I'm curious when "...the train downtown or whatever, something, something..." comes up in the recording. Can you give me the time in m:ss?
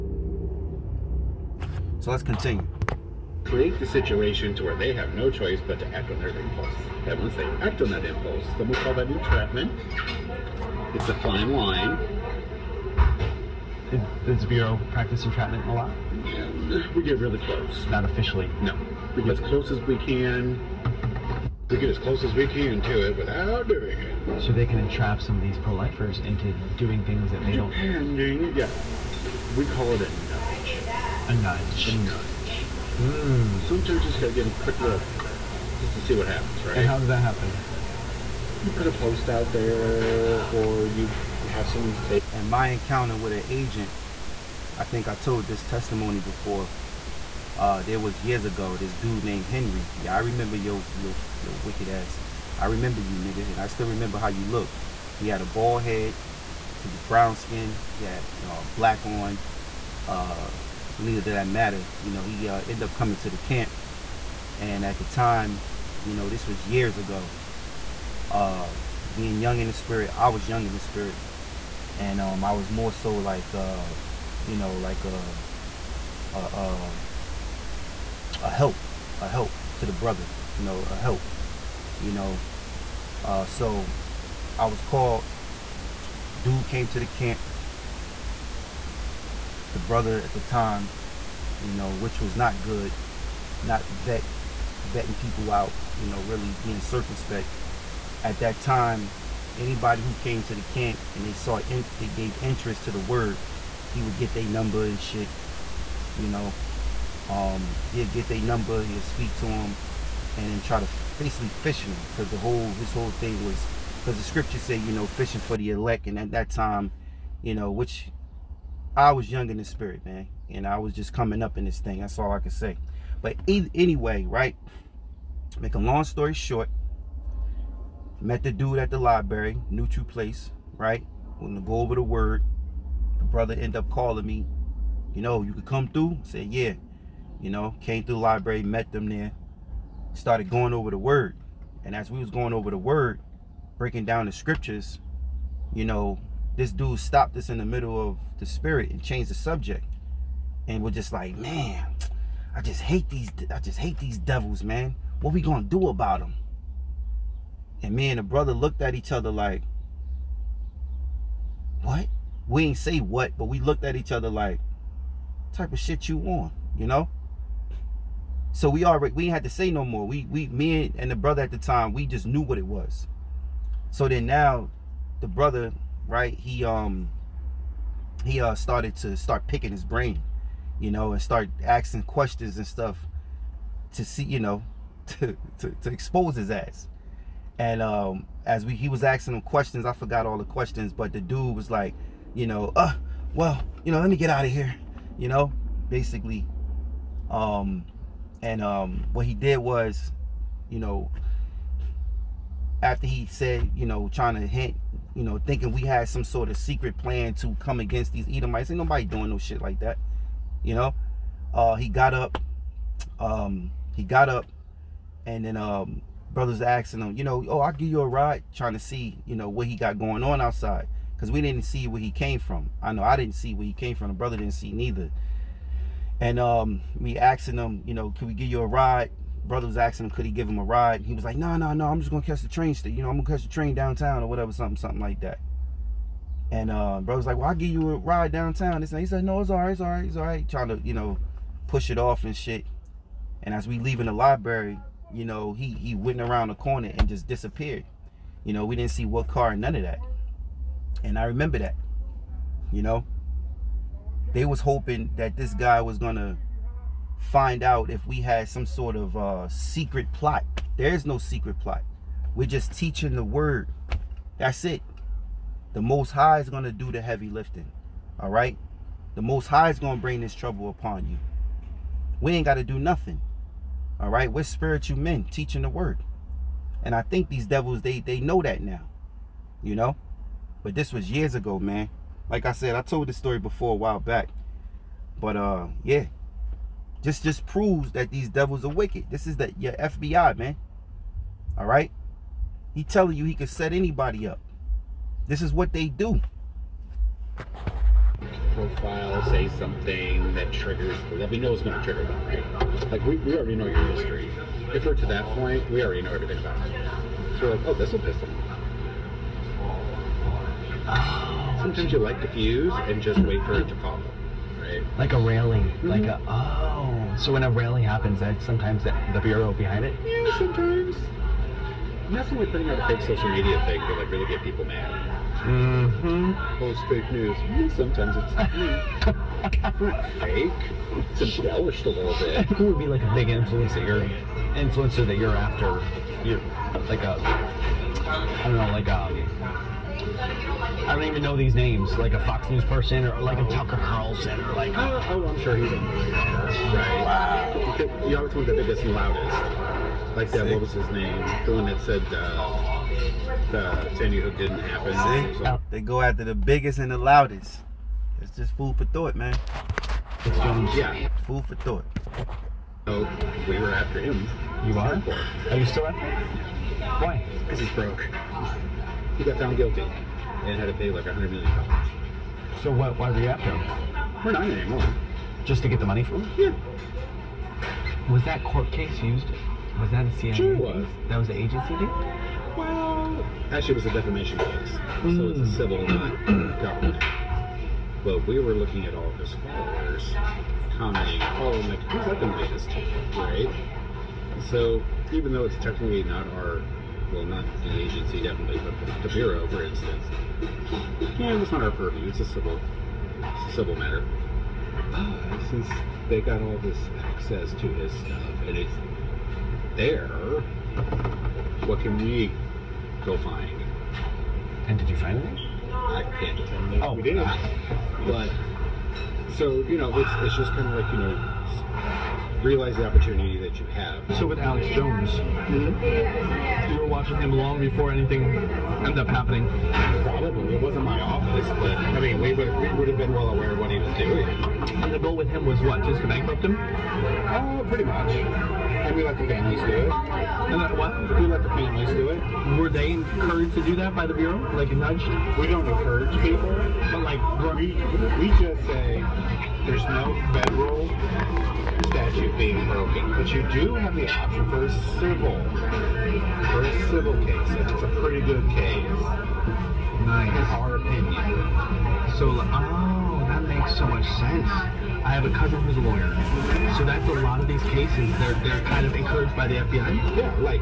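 3:53.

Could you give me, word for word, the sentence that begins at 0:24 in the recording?
So they can entrap some of these pro-lifers into doing things that they don't.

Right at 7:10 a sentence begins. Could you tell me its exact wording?
Probably it wasn't my office, but I mean we would we would have been well aware of what he was doing.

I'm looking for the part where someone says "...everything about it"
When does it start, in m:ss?
5:06.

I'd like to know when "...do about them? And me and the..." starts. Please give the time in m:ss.
2:35.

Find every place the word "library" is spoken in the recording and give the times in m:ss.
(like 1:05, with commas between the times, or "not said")
2:08, 2:18, 4:04.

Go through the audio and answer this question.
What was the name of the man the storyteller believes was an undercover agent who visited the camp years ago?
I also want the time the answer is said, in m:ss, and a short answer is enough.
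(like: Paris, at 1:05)
Henry, at 0:49.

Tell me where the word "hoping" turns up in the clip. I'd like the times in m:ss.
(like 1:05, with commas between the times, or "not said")
4:14.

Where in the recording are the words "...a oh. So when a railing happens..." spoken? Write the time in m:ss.
5:16.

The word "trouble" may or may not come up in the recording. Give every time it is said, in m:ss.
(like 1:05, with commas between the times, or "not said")
4:30.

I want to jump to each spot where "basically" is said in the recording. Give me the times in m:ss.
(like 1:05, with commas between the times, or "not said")
1:51, 3:15.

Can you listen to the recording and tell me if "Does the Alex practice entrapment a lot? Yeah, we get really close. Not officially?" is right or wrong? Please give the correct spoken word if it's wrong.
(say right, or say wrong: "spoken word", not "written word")
wrong: "Bureau", not "Alex".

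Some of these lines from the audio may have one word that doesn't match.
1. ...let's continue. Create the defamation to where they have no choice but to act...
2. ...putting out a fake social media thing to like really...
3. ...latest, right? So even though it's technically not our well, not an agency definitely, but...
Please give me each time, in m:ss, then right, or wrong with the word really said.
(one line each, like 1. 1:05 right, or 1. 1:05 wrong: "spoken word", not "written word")
1. 0:02 wrong: "situation", not "defamation"
2. 5:22 right
3. 6:32 right.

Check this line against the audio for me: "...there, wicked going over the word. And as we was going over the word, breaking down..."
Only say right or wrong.
wrong.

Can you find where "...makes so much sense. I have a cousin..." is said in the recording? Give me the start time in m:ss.
7:43.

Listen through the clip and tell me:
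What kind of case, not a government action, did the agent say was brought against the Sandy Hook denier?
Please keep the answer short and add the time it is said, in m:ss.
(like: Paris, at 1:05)
defamation case, at 6:23.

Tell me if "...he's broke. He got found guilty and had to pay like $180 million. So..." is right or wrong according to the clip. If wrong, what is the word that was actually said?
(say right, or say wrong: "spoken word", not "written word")
wrong: "100", not "180".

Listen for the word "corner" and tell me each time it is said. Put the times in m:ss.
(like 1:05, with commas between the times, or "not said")
4:06.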